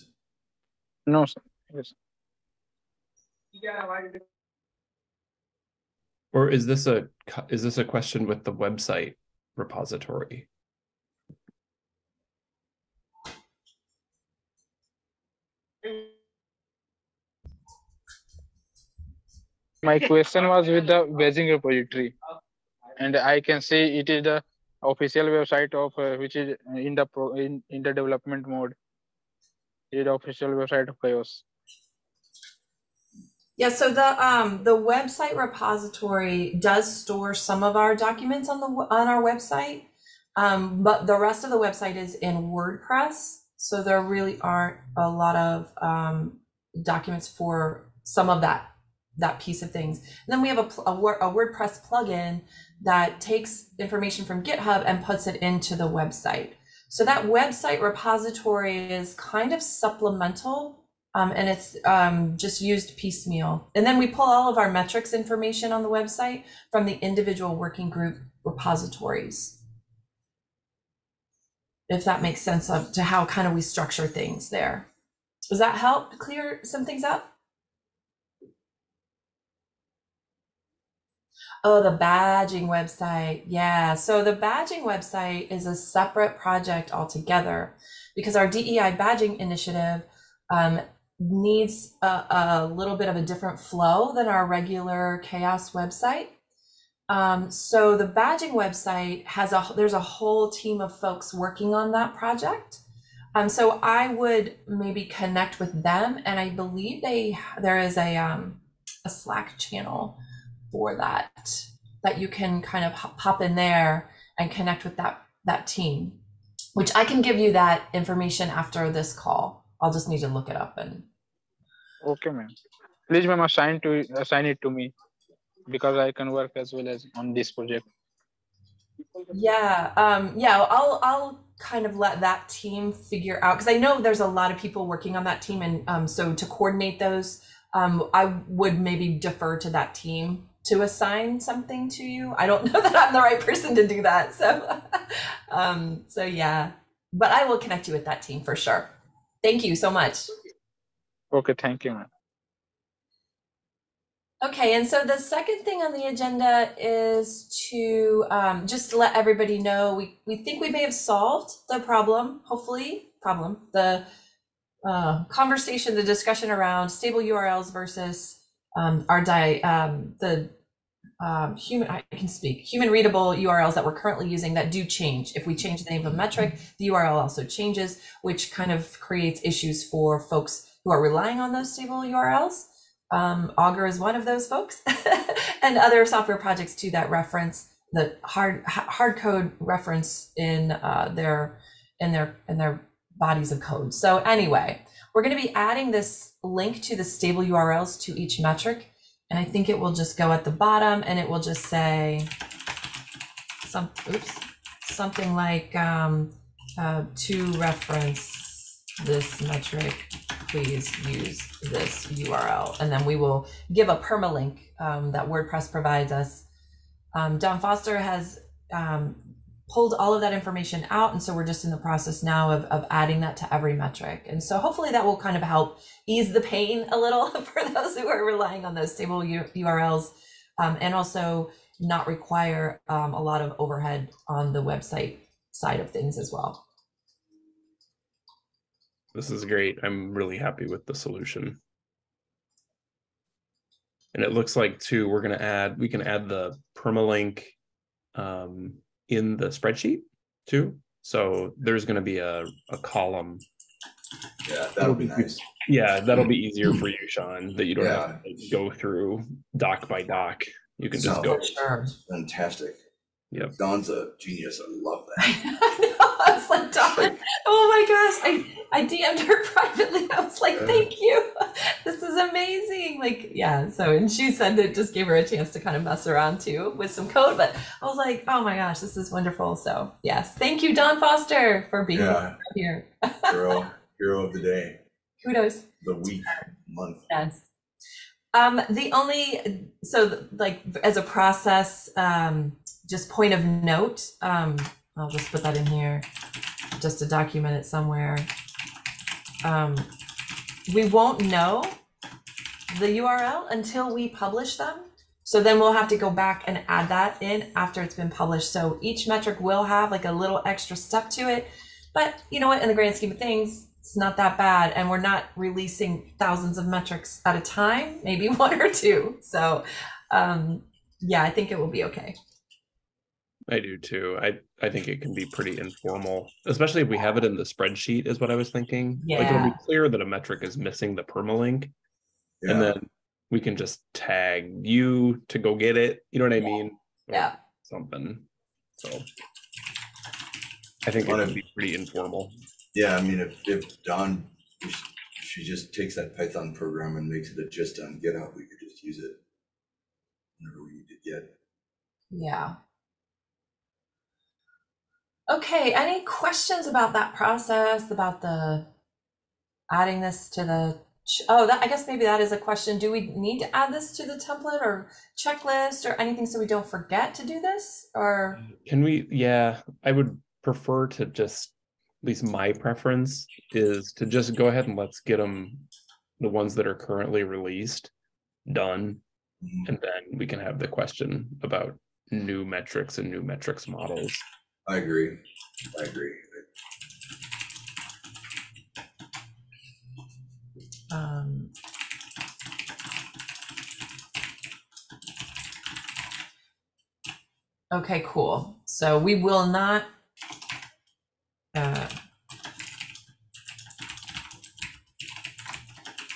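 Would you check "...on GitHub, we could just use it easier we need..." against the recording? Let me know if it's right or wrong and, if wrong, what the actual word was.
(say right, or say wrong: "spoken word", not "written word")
wrong: "whenever", not "easier".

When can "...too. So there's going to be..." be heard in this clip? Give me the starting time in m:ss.
4:10.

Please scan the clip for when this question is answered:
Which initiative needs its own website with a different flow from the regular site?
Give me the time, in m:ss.
1:28.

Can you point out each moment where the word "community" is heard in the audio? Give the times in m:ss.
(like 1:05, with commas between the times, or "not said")
not said.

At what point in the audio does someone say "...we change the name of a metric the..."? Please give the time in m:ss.
2:55.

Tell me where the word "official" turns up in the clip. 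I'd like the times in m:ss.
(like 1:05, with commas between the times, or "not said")
0:24, 0:30.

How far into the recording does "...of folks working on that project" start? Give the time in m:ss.
1:40.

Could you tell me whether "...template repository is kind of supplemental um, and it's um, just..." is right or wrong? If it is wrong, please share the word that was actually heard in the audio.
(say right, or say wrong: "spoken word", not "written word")
wrong: "website", not "template".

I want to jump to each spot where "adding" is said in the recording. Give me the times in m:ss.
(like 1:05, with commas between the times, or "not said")
3:15, 3:42, 5:59.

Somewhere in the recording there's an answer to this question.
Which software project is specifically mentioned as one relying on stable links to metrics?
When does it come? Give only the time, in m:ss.
3:03.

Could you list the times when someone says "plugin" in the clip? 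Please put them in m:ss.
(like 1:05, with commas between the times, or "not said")
0:51.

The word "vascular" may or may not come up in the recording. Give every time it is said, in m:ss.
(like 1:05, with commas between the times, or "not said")
not said.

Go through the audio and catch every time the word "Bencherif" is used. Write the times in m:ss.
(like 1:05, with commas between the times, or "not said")
not said.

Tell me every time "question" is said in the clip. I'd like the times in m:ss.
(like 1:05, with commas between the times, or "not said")
0:07, 0:19, 5:56, 6:02, 6:20.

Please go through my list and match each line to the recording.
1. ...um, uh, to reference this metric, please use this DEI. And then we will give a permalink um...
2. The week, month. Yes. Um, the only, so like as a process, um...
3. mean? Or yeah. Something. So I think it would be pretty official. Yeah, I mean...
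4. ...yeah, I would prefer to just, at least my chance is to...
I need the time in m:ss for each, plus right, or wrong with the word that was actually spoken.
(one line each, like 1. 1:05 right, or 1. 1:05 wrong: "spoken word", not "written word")
1. 3:25 wrong: "URL", not "DEI"
2. 4:45 right
3. 5:36 wrong: "informal", not "official"
4. 6:09 wrong: "preference", not "chance".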